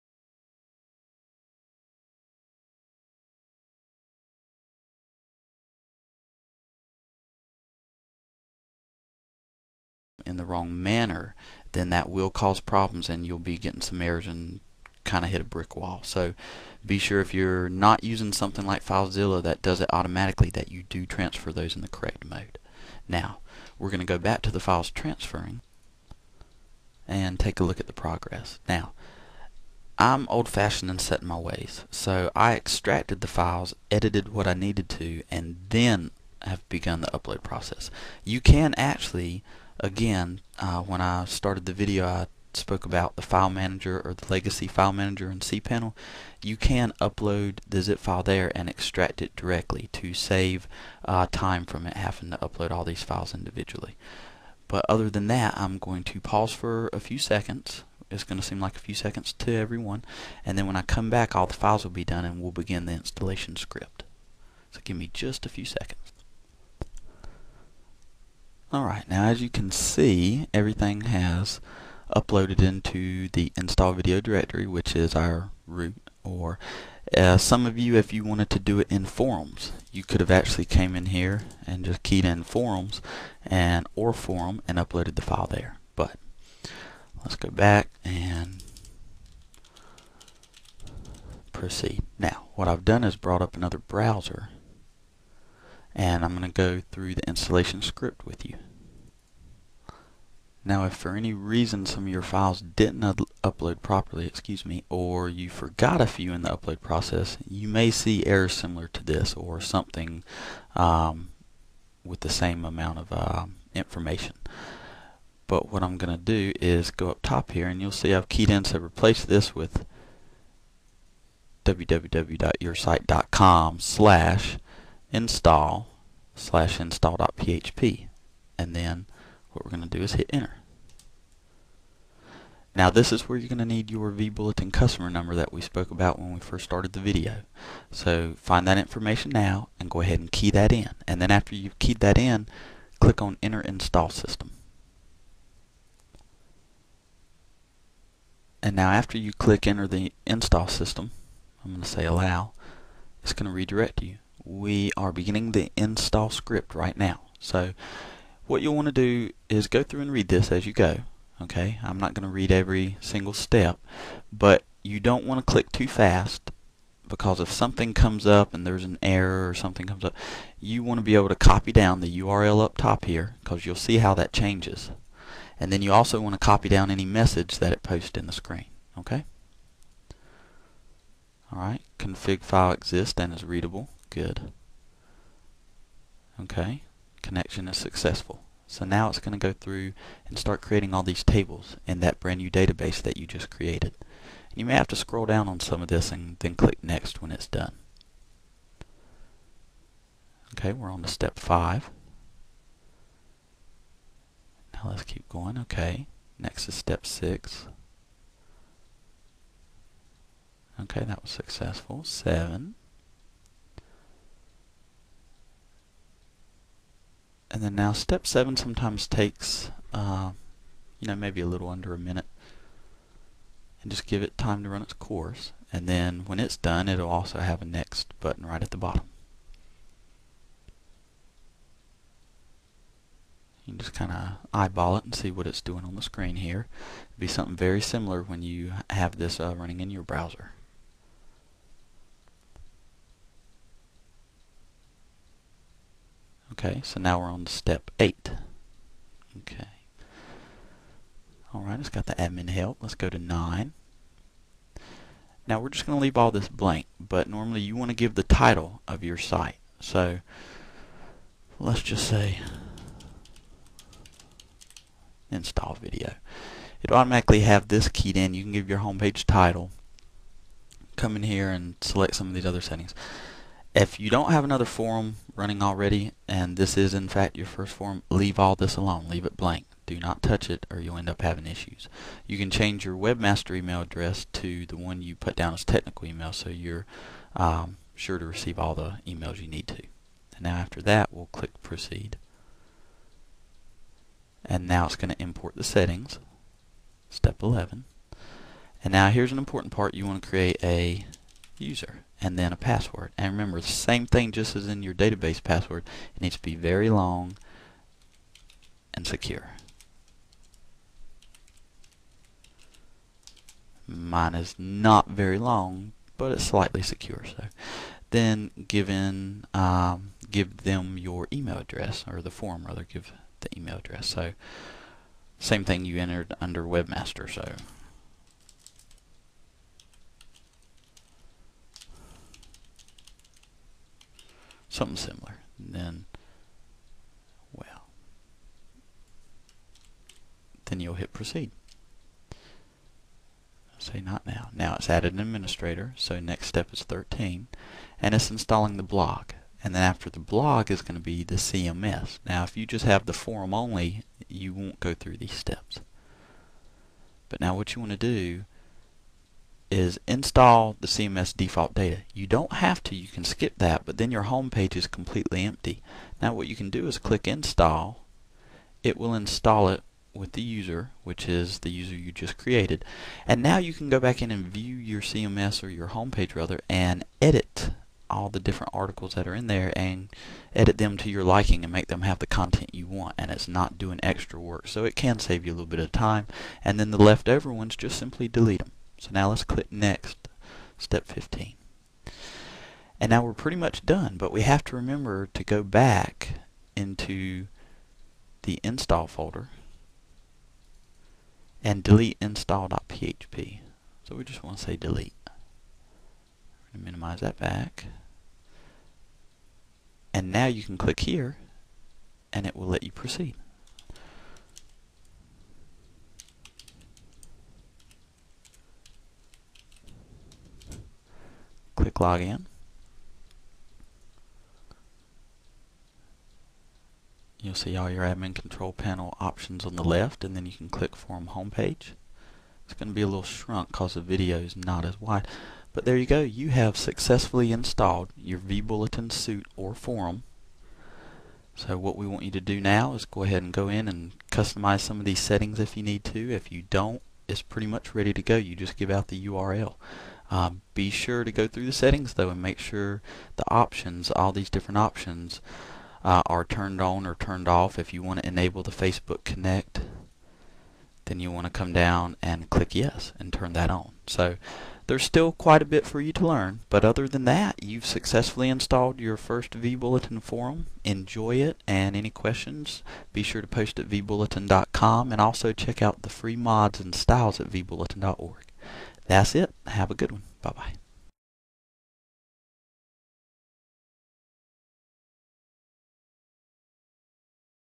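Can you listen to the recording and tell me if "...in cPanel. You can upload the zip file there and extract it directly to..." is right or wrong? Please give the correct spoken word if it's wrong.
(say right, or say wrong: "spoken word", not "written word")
right.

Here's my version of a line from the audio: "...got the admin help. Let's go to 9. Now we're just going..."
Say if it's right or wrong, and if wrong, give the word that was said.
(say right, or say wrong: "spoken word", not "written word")
right.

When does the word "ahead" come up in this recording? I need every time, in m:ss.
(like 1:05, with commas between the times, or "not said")
2:20, 7:23.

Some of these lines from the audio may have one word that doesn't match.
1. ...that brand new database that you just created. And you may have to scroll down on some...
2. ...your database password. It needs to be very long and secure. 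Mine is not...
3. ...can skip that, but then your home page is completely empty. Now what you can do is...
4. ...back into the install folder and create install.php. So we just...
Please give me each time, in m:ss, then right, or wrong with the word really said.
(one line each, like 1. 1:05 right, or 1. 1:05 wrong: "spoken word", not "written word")
1. 3:12 right
2. 5:04 right
3. 6:03 right
4. 6:35 wrong: "delete", not "create".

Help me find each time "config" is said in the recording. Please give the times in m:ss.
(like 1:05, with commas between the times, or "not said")
3:01.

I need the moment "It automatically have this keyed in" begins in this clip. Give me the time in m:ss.
4:26.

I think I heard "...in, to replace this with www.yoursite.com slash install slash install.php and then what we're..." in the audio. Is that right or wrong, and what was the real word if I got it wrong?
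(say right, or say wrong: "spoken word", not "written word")
right.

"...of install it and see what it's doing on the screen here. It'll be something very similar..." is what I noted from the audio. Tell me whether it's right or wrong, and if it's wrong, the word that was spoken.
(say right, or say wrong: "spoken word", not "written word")
wrong: "eyeball", not "install".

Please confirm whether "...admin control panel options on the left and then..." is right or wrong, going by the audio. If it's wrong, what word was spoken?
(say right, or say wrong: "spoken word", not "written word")
right.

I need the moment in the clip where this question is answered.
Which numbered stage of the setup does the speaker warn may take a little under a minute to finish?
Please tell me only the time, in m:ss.
3:37.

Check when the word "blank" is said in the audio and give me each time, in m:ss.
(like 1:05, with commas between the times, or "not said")
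4:16, 4:39.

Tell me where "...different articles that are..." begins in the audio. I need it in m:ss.
6:18.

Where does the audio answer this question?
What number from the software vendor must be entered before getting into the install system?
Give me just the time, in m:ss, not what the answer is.
2:14.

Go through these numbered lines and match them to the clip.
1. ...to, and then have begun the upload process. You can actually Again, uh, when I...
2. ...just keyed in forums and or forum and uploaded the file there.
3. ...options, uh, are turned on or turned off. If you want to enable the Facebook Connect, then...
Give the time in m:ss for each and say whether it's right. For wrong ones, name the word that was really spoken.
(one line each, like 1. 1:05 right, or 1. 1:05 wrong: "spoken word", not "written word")
1. 0:34 right
2. 1:21 right
3. 7:34 right.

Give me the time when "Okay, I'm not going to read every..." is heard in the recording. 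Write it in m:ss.
2:41.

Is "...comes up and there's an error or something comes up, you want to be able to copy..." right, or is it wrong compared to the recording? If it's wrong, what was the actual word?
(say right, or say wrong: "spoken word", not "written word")
right.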